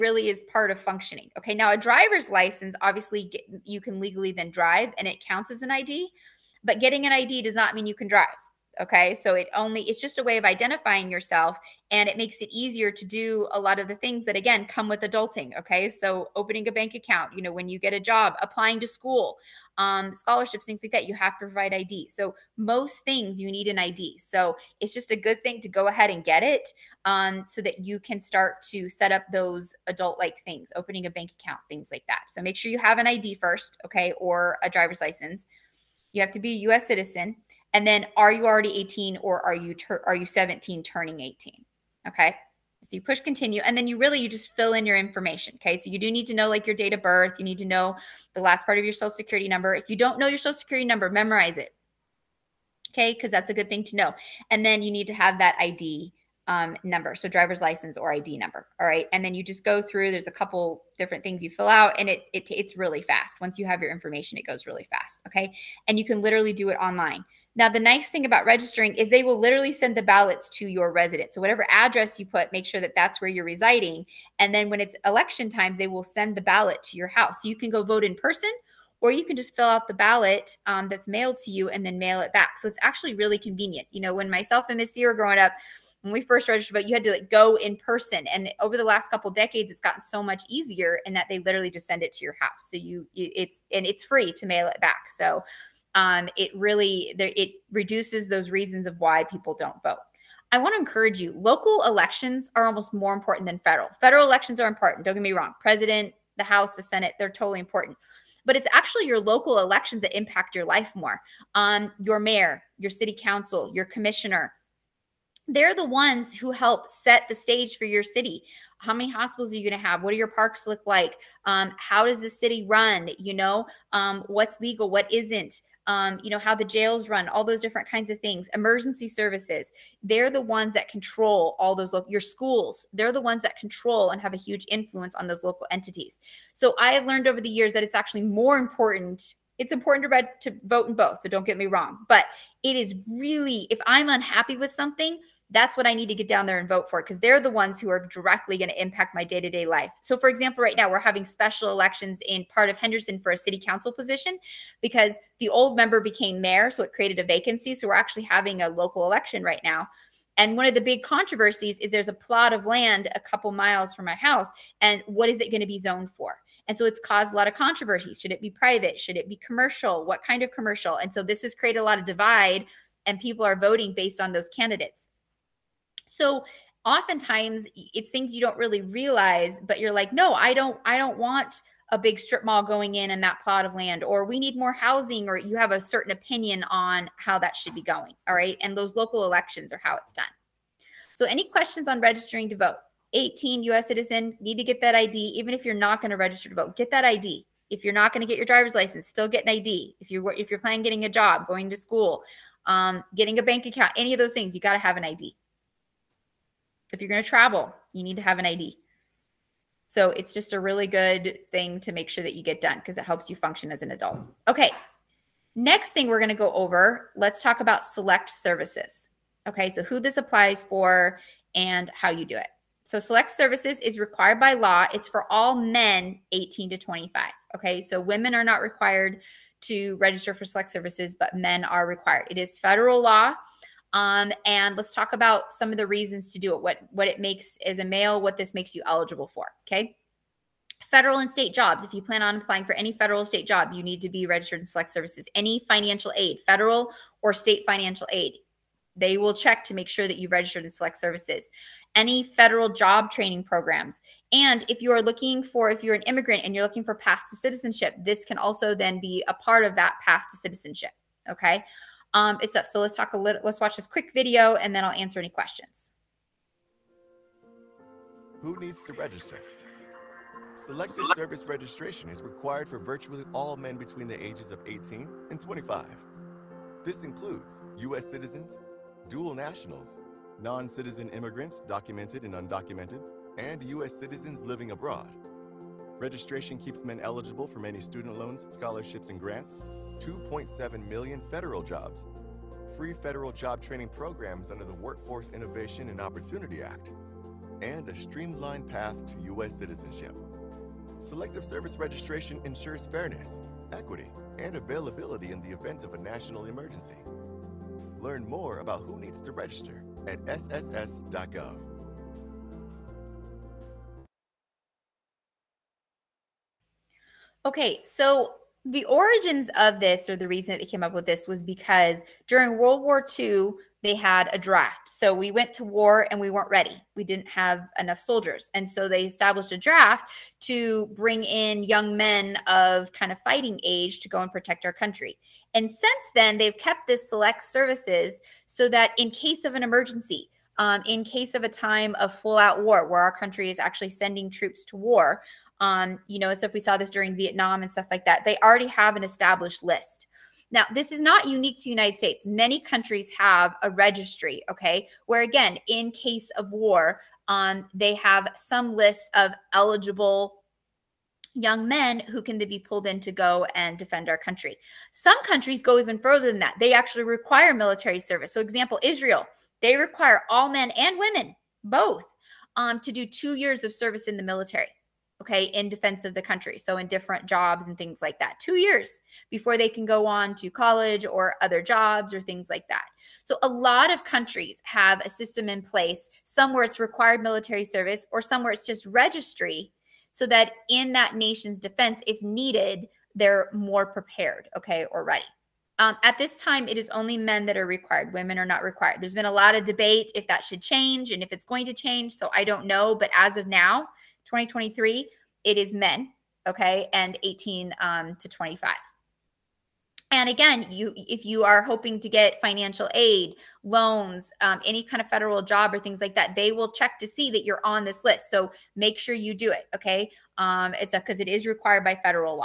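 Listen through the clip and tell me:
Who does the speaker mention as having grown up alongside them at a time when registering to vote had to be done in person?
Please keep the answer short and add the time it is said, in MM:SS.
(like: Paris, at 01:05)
Missy, at 01:24.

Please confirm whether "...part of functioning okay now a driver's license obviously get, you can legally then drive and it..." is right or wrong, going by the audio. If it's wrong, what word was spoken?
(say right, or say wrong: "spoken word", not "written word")
right.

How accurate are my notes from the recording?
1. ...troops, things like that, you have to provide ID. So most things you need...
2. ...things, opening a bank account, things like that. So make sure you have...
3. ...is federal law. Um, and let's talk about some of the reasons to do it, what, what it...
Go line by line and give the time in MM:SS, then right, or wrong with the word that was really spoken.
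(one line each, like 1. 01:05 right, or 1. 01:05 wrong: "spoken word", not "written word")
1. 00:20 wrong: "scholarships", not "troops"
2. 00:30 right
3. 03:52 right.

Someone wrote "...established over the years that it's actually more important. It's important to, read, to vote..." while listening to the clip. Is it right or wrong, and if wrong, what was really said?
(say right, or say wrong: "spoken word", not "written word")
wrong: "learned", not "established".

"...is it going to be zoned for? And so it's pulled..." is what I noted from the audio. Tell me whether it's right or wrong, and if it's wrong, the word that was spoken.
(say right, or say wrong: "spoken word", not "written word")
wrong: "caused", not "pulled".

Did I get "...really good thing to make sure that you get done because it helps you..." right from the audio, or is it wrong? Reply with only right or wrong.
right.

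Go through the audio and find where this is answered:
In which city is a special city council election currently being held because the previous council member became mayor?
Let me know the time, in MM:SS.
02:32.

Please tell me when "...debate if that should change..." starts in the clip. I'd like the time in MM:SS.
06:39.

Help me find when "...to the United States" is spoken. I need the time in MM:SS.
05:51.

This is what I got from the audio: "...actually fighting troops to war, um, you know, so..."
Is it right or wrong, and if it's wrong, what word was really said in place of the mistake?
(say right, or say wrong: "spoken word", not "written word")
wrong: "sending", not "fighting".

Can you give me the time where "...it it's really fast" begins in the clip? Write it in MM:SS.
01:02.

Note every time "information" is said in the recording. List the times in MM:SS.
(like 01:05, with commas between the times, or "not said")
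00:44, 01:03.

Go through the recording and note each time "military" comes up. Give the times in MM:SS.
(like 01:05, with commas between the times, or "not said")
06:07, 06:14, 06:27.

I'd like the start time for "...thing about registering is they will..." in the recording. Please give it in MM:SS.
01:08.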